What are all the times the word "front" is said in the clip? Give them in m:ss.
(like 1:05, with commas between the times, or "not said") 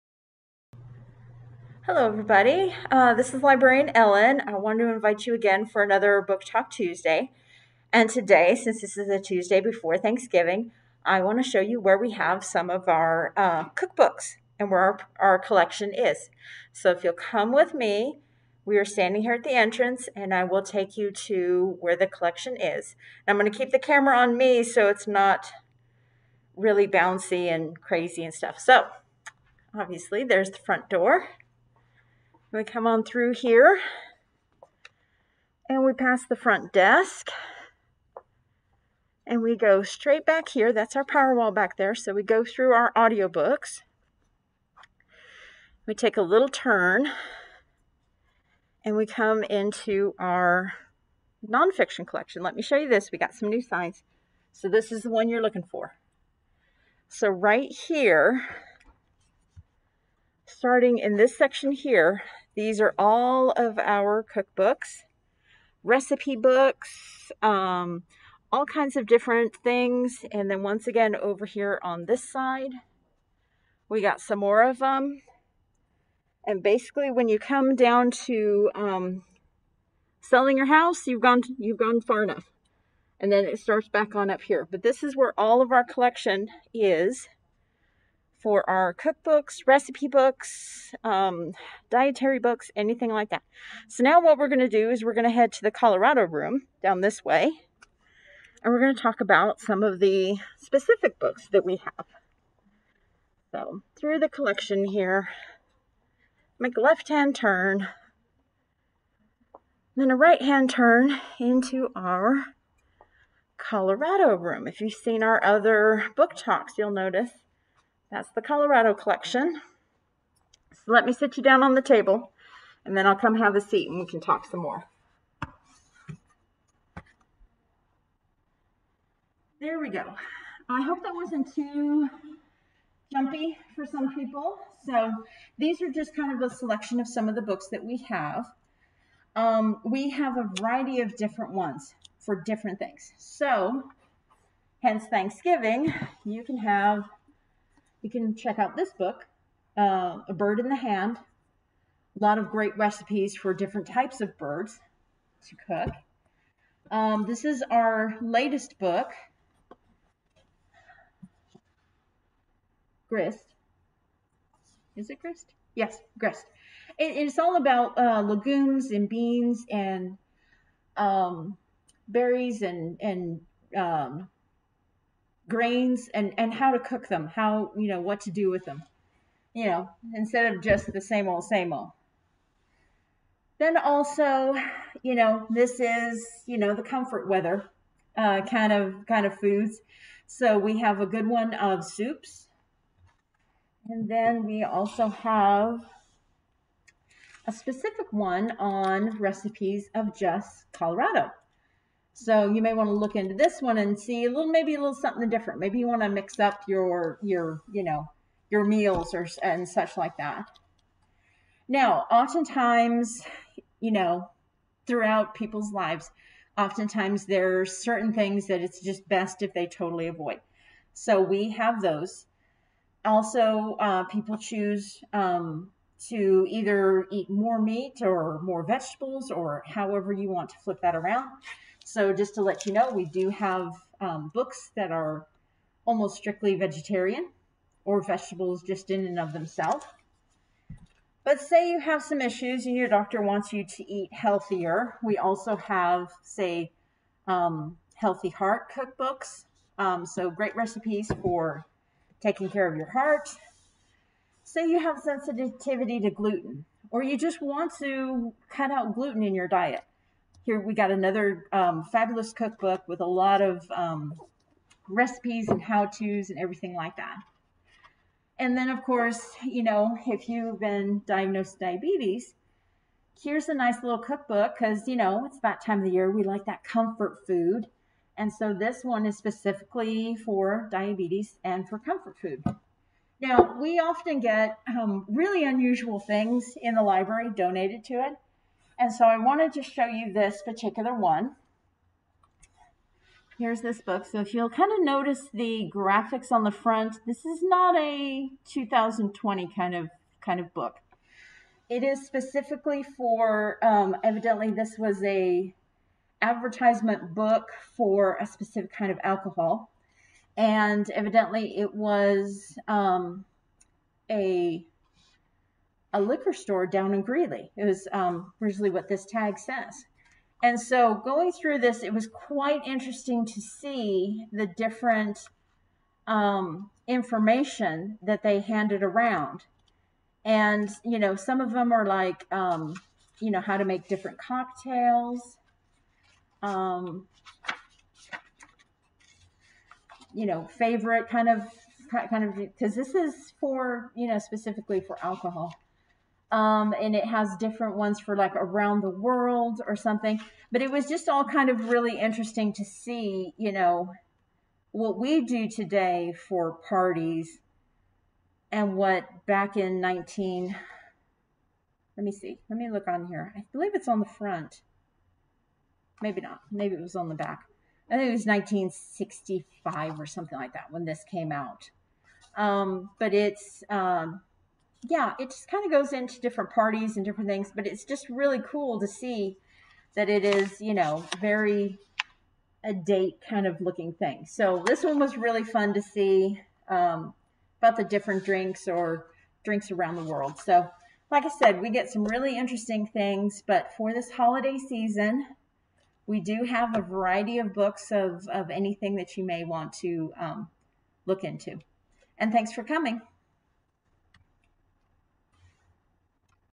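0:30, 0:36, 4:56, 6:04.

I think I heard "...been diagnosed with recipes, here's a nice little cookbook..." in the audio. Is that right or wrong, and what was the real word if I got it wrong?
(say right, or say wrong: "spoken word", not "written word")
wrong: "diabetes", not "recipes".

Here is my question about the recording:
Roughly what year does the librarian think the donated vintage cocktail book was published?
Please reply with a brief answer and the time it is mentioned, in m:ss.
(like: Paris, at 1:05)
1965, at 6:08.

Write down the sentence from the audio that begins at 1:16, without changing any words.
And basically, when you come down to um, selling your house, you've gone you've gone far enough.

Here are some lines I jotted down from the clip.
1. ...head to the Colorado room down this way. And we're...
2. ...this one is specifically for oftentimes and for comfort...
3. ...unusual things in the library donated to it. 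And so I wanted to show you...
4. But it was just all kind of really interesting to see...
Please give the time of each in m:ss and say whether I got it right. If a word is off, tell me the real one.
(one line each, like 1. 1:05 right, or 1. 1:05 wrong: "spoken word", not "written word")
1. 1:35 right
2. 4:38 wrong: "diabetes", not "oftentimes"
3. 4:45 right
4. 5:50 right.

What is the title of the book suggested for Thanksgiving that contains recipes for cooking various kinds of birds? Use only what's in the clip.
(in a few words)
A Bird in the Hand.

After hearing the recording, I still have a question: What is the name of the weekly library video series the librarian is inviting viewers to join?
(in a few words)
Book Talk Tuesday.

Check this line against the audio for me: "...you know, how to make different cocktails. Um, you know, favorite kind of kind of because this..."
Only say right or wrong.
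right.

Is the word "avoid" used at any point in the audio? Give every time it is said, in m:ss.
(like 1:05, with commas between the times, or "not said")
3:40.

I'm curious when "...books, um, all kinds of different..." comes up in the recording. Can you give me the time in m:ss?
1:06.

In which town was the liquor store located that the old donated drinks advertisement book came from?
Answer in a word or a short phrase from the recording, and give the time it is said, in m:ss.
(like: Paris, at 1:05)
Greeley, at 5:17.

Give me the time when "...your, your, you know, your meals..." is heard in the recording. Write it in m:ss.
3:26.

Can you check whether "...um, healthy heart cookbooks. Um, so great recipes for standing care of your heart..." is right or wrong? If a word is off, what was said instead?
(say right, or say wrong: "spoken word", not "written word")
wrong: "taking", not "standing".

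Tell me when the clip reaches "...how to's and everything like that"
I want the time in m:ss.
4:25.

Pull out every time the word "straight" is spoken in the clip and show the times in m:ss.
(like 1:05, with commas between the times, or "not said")
0:39.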